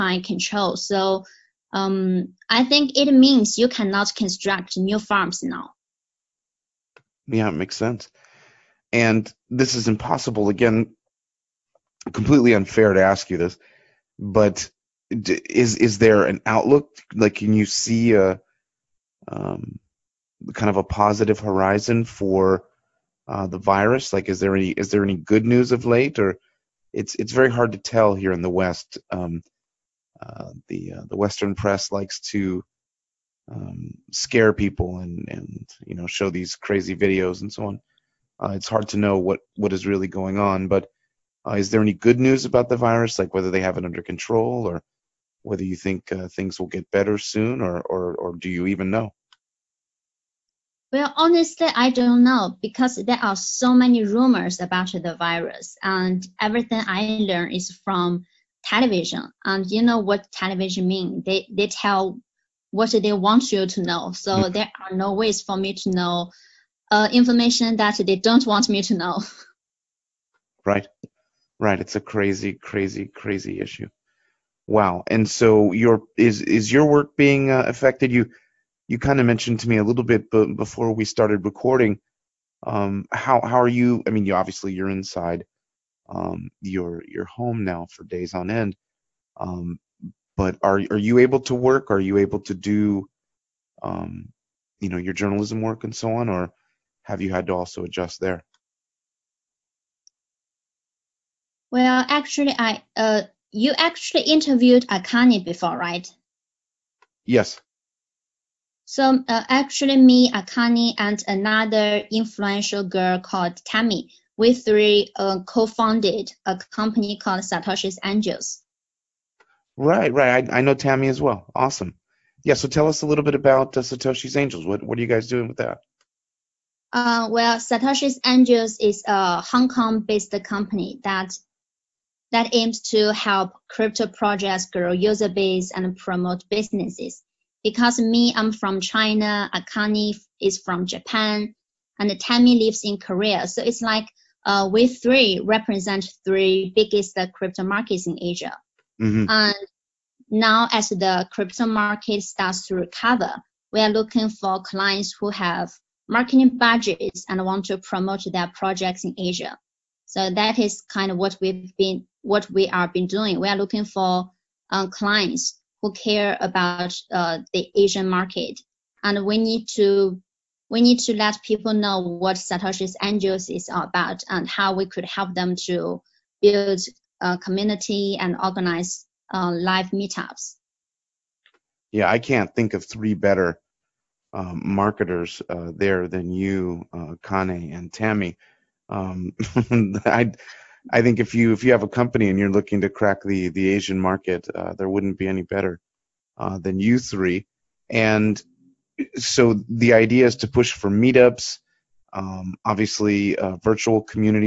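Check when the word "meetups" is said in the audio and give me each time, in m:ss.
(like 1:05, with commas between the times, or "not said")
2:59, 3:20.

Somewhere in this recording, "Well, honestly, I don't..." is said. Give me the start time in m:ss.
0:50.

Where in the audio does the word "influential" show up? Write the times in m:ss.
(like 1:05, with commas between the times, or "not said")
1:52.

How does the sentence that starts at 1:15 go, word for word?
And so your is is your work being uh, affected?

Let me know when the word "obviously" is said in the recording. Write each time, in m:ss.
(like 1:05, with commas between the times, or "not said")
1:24, 3:22.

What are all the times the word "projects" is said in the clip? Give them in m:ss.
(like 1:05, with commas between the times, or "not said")
2:14, 2:38.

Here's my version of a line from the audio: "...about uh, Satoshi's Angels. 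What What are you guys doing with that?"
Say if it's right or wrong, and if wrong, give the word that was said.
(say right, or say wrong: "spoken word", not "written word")
right.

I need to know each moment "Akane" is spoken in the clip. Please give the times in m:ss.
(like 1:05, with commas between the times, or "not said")
1:44, 1:50, 2:19.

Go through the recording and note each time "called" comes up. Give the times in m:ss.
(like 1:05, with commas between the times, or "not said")
1:53, 1:57.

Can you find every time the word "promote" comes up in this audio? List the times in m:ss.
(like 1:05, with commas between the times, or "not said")
2:15, 2:37.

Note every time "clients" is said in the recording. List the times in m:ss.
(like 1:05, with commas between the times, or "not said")
2:34, 2:44.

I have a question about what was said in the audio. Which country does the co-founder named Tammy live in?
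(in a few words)
Korea.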